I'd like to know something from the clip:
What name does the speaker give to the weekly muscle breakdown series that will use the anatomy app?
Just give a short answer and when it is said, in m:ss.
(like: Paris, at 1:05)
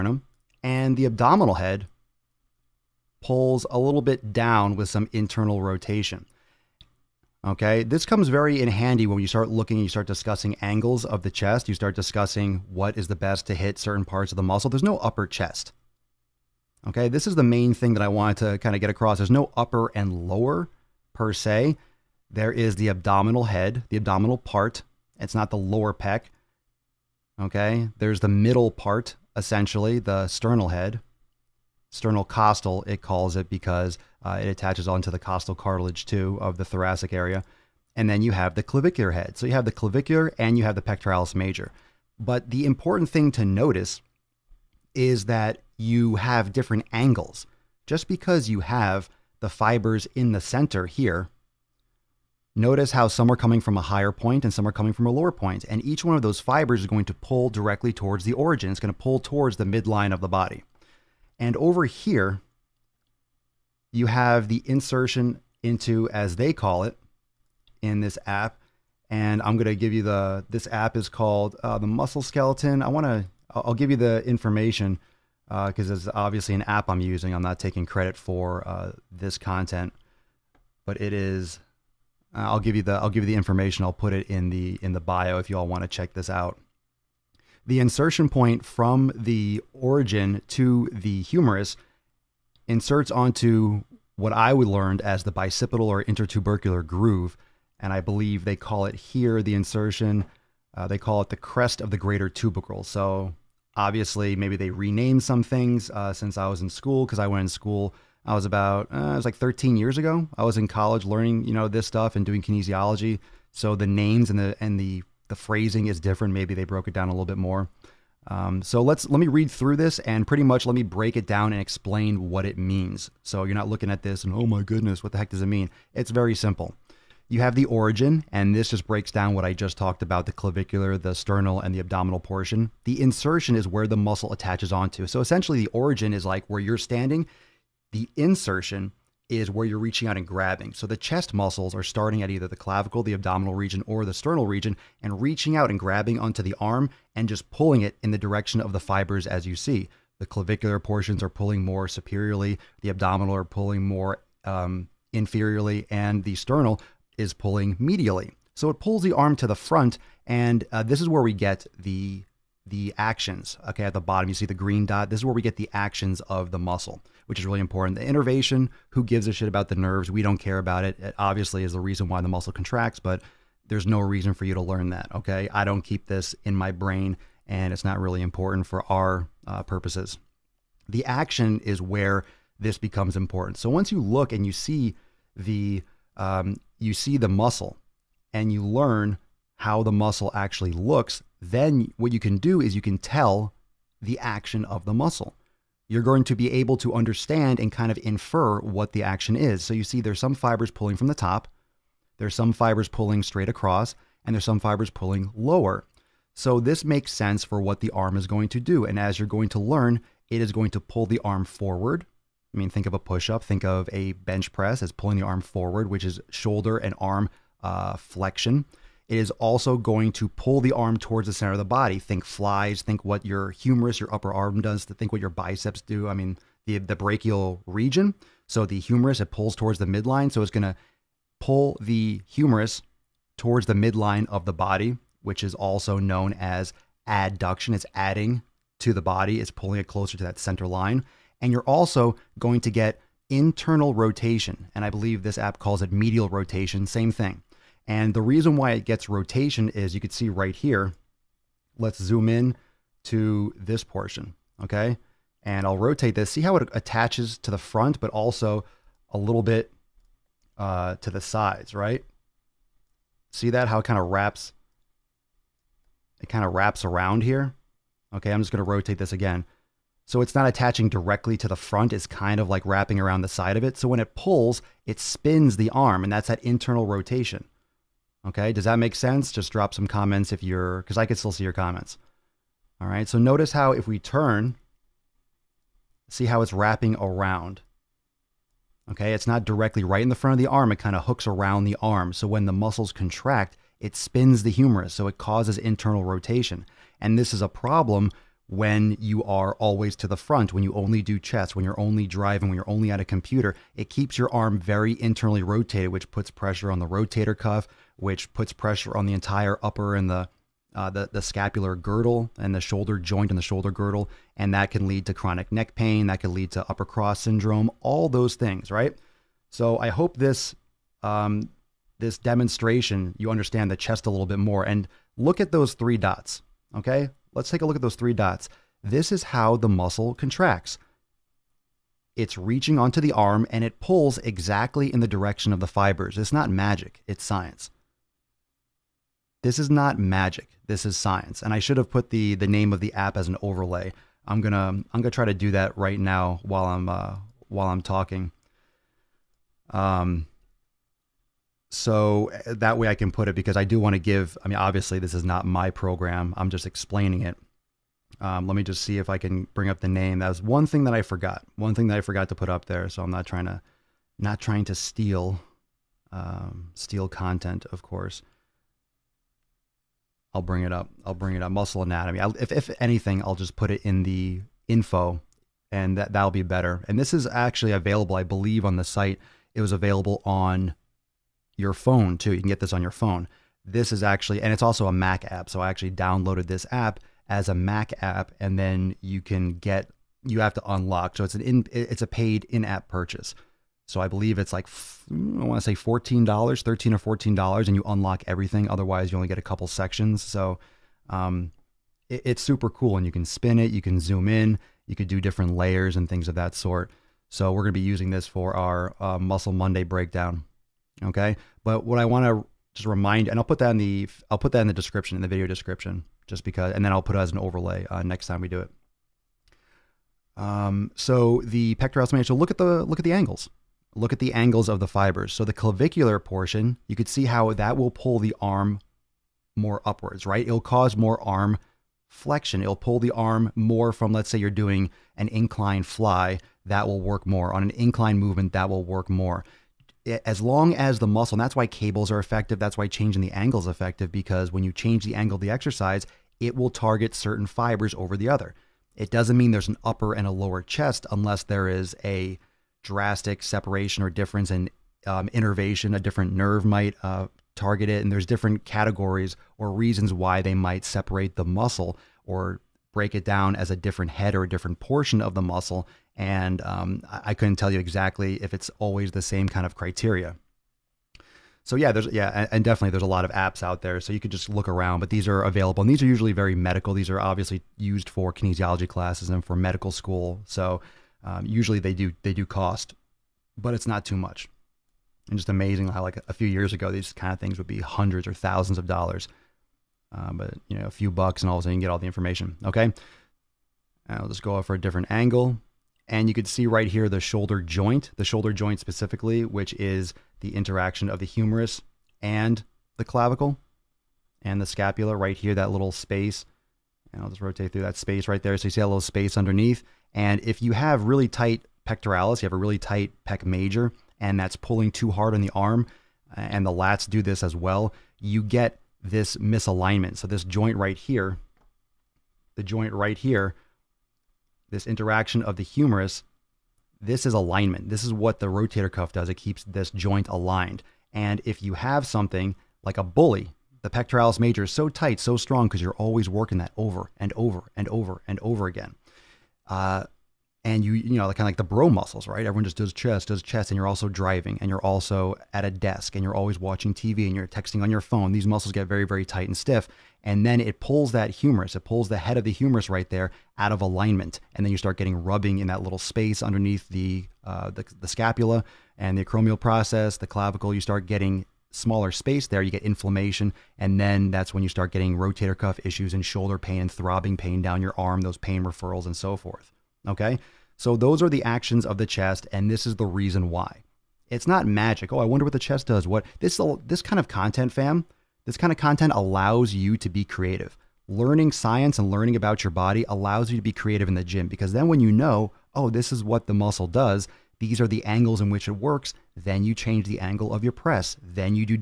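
Muscle Monday, at 6:49.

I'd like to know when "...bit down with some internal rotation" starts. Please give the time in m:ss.
0:04.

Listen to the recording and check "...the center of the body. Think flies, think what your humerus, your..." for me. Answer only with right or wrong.
right.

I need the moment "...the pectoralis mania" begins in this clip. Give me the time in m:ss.
7:01.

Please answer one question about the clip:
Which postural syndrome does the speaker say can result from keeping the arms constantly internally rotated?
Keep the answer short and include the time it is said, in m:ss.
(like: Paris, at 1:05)
upper cross syndrome, at 5:16.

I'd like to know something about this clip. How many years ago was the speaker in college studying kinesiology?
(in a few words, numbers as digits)
13.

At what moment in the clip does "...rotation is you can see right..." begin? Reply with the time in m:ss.
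4:09.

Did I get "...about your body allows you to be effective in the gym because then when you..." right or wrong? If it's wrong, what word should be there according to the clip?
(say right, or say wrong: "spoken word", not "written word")
wrong: "creative", not "effective".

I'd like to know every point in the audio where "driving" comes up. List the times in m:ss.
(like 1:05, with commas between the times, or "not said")
5:02, 9:04.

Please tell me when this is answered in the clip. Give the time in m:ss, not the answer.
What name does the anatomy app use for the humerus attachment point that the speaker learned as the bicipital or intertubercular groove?
1:41.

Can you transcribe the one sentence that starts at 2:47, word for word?
The innervation, who gives a shit about the nerves?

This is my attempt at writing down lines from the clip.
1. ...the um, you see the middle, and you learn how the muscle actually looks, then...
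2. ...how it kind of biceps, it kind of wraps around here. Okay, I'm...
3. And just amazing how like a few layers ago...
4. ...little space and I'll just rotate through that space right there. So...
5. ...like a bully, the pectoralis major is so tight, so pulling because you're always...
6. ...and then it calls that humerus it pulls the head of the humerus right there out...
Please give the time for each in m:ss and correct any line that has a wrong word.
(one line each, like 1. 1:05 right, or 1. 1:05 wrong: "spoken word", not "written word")
1. 3:05 wrong: "muscle", not "middle"
2. 4:23 wrong: "wraps", not "biceps"
3. 8:05 wrong: "years", not "layers"
4. 8:25 right
5. 8:52 wrong: "strong", not "pulling"
6. 9:10 wrong: "pulls", not "calls".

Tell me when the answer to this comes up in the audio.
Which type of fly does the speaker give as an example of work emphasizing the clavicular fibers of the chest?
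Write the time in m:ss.
7:15.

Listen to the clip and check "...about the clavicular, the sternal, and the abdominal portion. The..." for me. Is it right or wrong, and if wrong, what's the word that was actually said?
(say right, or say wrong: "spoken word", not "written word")
right.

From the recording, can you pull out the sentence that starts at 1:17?
I'm not taking credit for uh, this content, but it is.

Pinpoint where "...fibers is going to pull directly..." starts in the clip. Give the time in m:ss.
0:56.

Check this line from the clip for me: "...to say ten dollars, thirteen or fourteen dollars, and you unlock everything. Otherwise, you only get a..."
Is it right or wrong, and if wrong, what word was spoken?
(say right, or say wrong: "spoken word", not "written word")
wrong: "fourteen", not "ten".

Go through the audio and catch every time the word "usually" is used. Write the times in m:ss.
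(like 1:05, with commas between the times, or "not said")
7:56, 8:01.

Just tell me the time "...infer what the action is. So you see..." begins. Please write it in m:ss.
3:18.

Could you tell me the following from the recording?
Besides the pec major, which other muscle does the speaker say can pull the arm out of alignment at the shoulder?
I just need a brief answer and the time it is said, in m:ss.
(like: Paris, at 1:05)
lats, at 8:36.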